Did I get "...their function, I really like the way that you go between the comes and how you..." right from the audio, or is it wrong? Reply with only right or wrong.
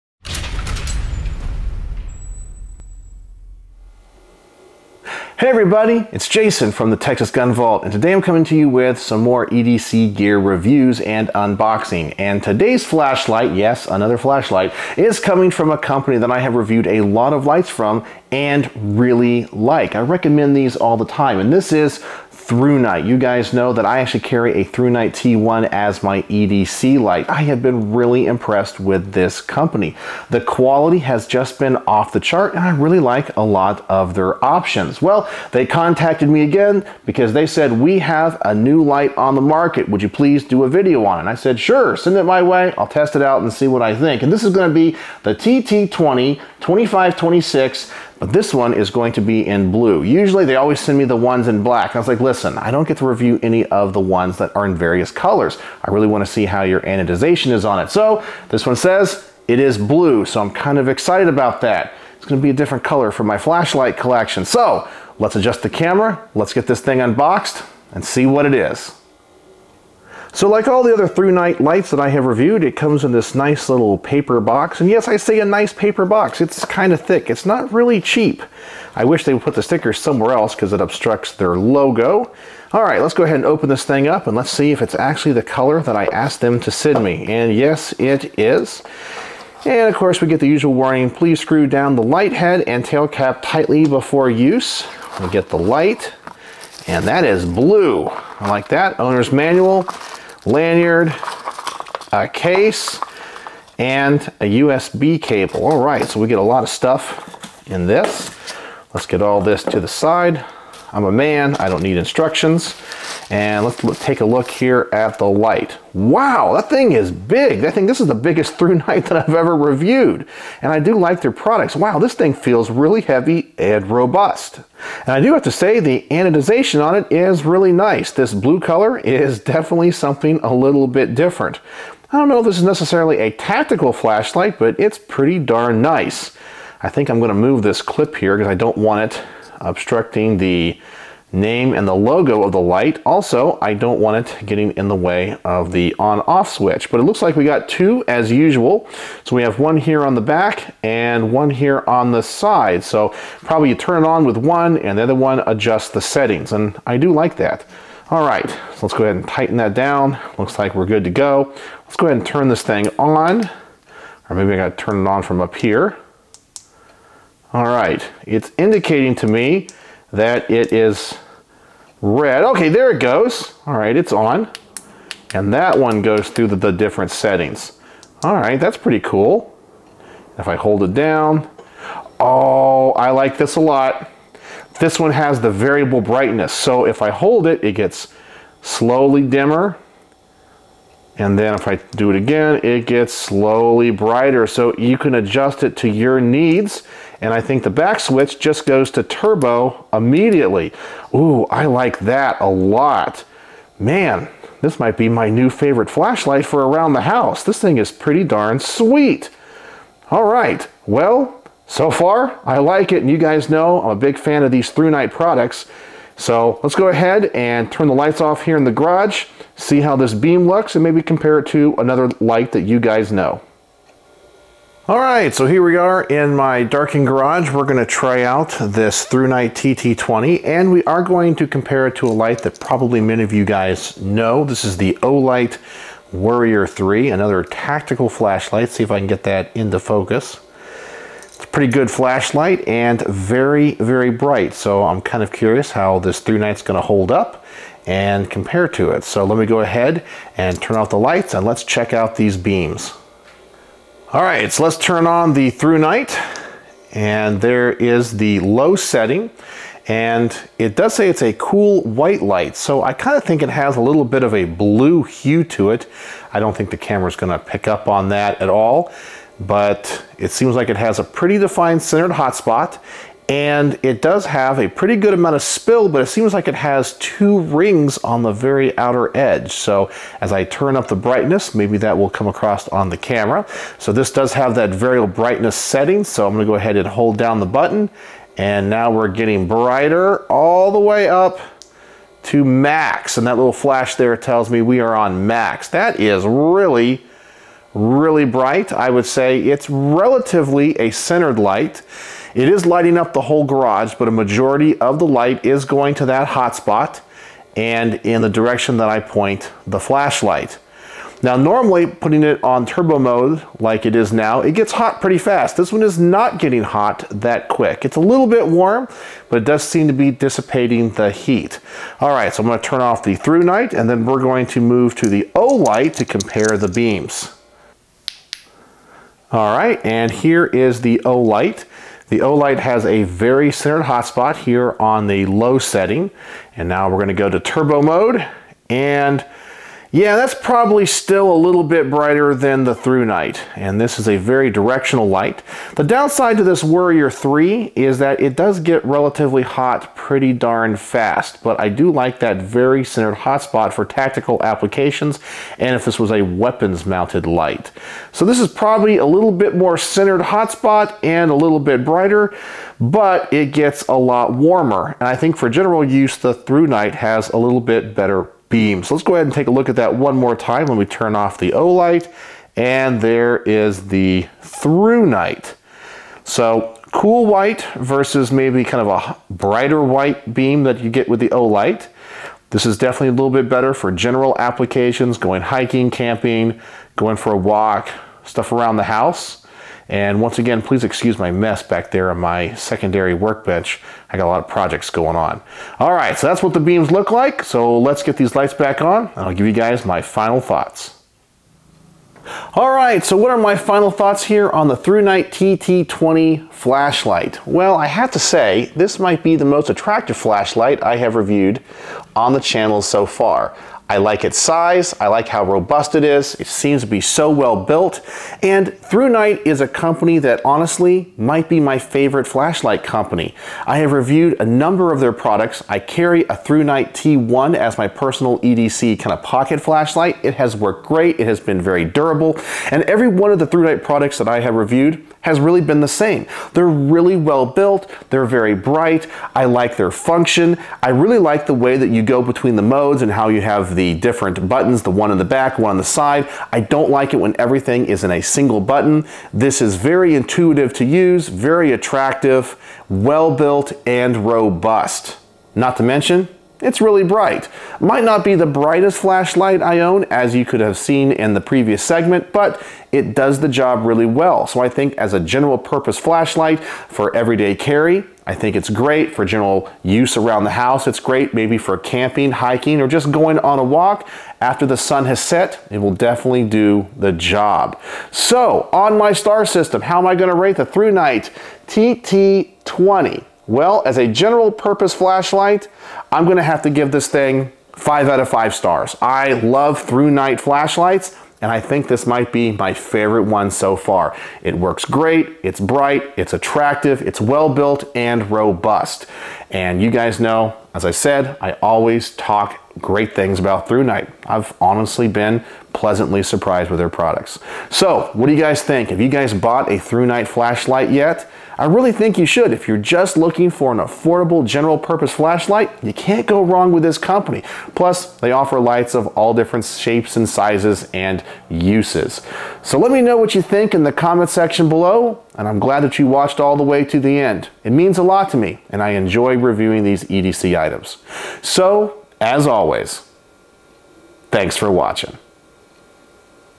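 wrong.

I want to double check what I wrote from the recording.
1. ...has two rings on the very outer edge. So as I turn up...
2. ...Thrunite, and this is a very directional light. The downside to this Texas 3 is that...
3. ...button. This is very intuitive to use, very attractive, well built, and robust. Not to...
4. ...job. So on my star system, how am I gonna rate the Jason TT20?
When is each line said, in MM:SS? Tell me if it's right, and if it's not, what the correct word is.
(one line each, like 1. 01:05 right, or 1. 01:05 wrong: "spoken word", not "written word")
1. 04:36 right
2. 05:42 wrong: "Warrior", not "Texas"
3. 07:28 right
4. 07:57 wrong: "Thrunite", not "Jason".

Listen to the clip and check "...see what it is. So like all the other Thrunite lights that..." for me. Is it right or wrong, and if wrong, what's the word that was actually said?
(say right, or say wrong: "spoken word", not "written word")
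right.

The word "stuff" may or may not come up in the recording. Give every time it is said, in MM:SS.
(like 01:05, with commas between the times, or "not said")
01:46, 06:28.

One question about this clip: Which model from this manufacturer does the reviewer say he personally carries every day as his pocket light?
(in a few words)
Thrunite T1.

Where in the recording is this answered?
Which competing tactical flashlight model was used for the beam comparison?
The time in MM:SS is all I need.
03:55.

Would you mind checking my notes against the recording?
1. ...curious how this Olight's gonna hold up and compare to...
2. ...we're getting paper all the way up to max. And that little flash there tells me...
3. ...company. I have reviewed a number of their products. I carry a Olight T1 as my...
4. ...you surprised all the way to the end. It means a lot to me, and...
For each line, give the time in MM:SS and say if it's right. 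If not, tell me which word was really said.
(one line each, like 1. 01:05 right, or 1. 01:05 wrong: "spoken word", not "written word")
1. 04:05 wrong: "Thrunite", not "Olight"
2. 04:48 wrong: "brighter", not "paper"
3. 07:02 wrong: "Night", not "Olight"
4. 08:45 wrong: "watched", not "surprised".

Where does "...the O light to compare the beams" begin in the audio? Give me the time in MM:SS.
05:25.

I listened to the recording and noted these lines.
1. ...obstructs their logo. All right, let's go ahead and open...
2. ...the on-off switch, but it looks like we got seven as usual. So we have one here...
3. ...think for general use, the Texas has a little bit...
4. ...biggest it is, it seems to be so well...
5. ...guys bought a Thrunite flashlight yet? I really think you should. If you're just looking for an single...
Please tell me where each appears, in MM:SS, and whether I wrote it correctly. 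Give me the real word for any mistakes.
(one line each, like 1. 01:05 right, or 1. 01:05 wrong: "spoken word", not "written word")
1. 01:20 right
2. 02:25 wrong: "two", not "seven"
3. 06:05 wrong: "Thrunite", not "Texas"
4. 06:55 wrong: "robust", not "biggest"
5. 08:29 wrong: "affordable", not "single".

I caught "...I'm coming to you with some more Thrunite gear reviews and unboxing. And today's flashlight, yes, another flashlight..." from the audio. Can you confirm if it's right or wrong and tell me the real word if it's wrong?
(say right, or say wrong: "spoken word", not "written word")
wrong: "EDC", not "Thrunite".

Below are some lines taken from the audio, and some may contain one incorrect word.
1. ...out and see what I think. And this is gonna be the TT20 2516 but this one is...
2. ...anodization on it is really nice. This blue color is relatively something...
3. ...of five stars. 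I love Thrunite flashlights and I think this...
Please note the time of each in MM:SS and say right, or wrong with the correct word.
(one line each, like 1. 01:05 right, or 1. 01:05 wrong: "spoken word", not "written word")
1. 00:43 wrong: "2526", not "2516"
2. 02:06 wrong: "definitely", not "relatively"
3. 08:08 right.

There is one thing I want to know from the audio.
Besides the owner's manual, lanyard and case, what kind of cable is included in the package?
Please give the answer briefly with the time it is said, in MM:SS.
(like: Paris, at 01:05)
USB cable, at 01:44.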